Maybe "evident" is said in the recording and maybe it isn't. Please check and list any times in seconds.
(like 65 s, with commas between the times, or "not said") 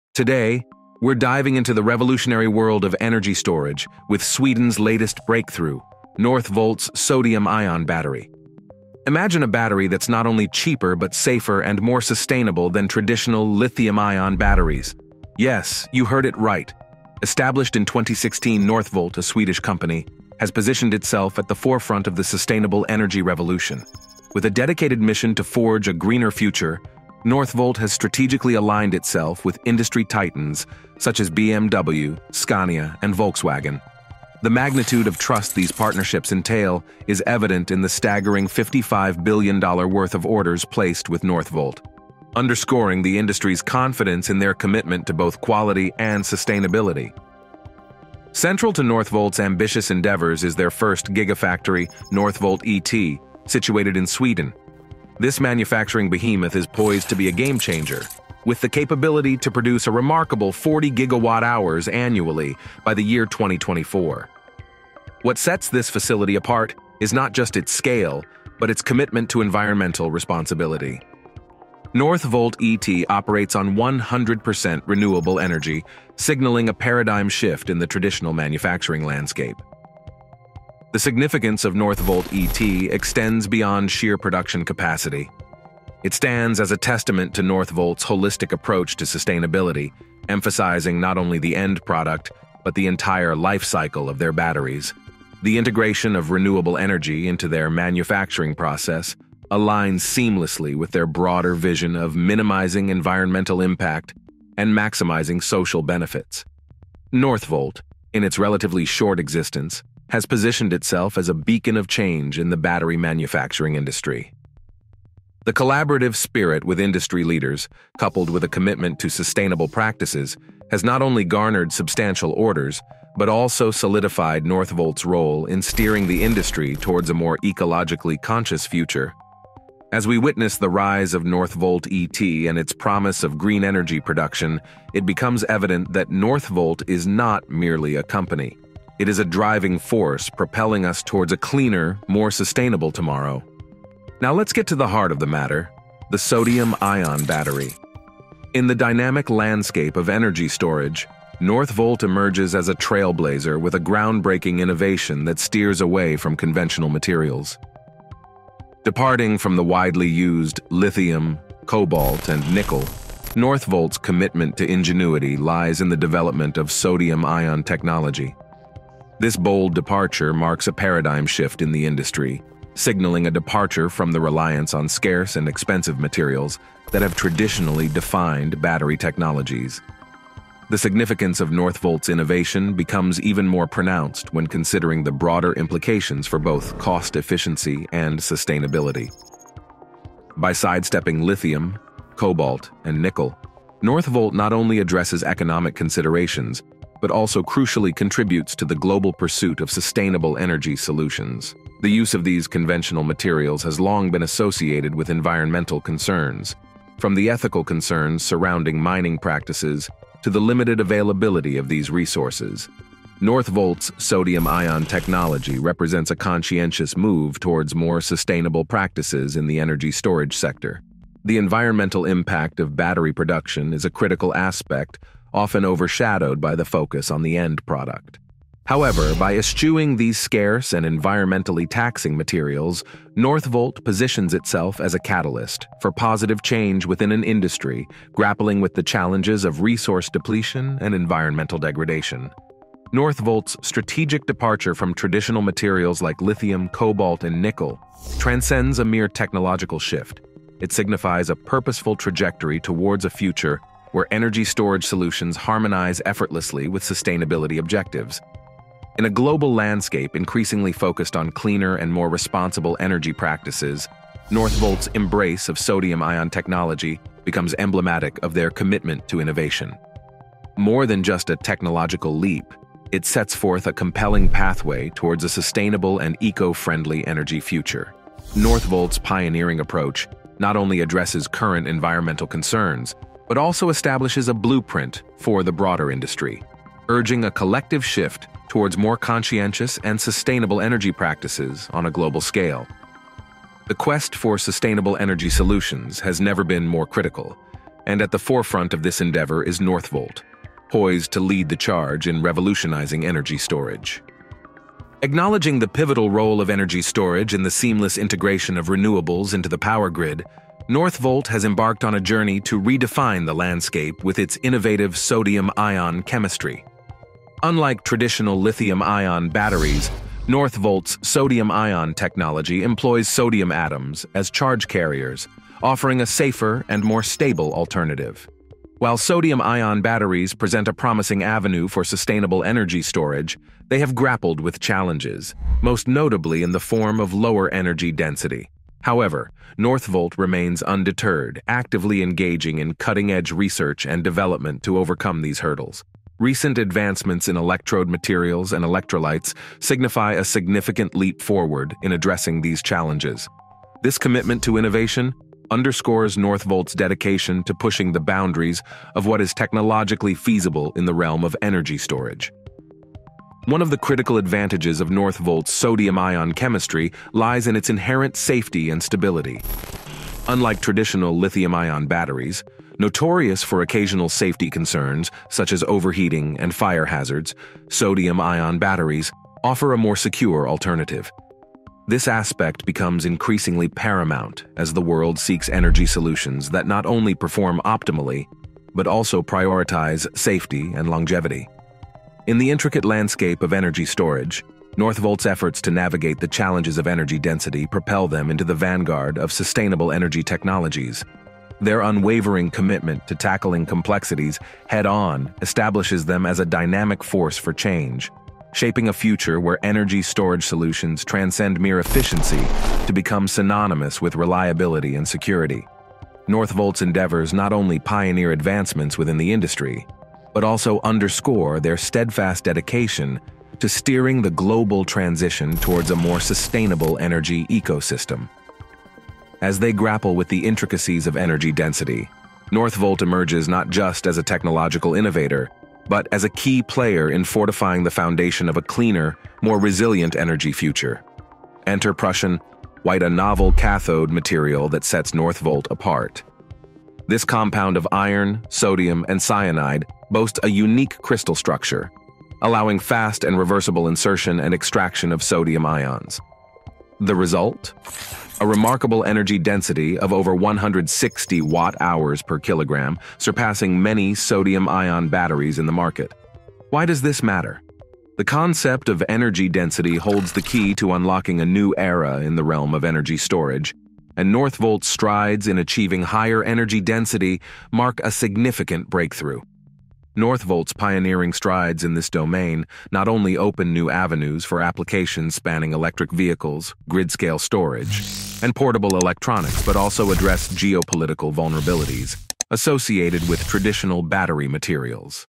37 s, 135 s.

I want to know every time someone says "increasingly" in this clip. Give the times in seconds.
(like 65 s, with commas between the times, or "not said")
260 s, 383 s.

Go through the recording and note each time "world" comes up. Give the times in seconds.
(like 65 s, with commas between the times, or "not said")
2 s, 384 s.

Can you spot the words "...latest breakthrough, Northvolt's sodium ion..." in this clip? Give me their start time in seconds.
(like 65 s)
4 s.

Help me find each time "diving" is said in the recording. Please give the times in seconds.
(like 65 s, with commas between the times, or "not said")
1 s.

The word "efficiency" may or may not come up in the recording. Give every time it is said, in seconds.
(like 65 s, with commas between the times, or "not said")
187 s, 411 s.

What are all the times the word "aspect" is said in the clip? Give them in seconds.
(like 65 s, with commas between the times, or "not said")
224 s, 382 s.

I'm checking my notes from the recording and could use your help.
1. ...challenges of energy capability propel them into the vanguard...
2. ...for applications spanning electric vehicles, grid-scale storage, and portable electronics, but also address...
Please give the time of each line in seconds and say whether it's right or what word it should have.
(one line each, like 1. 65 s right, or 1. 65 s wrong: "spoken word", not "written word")
1. 396 s wrong: "density", not "capability"
2. 484 s right.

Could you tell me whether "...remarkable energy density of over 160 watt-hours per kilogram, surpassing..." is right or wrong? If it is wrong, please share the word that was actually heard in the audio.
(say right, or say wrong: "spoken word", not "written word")
right.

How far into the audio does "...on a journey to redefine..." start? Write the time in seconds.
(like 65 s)
311 s.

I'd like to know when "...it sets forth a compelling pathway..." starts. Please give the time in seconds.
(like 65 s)
272 s.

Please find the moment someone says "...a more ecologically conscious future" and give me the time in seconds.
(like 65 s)
127 s.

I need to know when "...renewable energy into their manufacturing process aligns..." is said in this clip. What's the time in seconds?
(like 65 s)
96 s.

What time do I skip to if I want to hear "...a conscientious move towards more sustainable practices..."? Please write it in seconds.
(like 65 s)
216 s.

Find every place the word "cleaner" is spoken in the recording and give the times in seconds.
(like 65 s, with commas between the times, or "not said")
141 s, 261 s, 438 s.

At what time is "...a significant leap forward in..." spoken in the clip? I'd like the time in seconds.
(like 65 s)
350 s.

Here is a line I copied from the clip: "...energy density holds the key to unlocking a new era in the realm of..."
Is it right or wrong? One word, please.
right.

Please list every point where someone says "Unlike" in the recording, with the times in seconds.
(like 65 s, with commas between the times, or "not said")
317 s, 370 s.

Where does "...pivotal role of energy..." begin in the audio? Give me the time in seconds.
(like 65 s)
305 s.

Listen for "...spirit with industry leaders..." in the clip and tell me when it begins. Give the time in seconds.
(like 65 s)
116 s.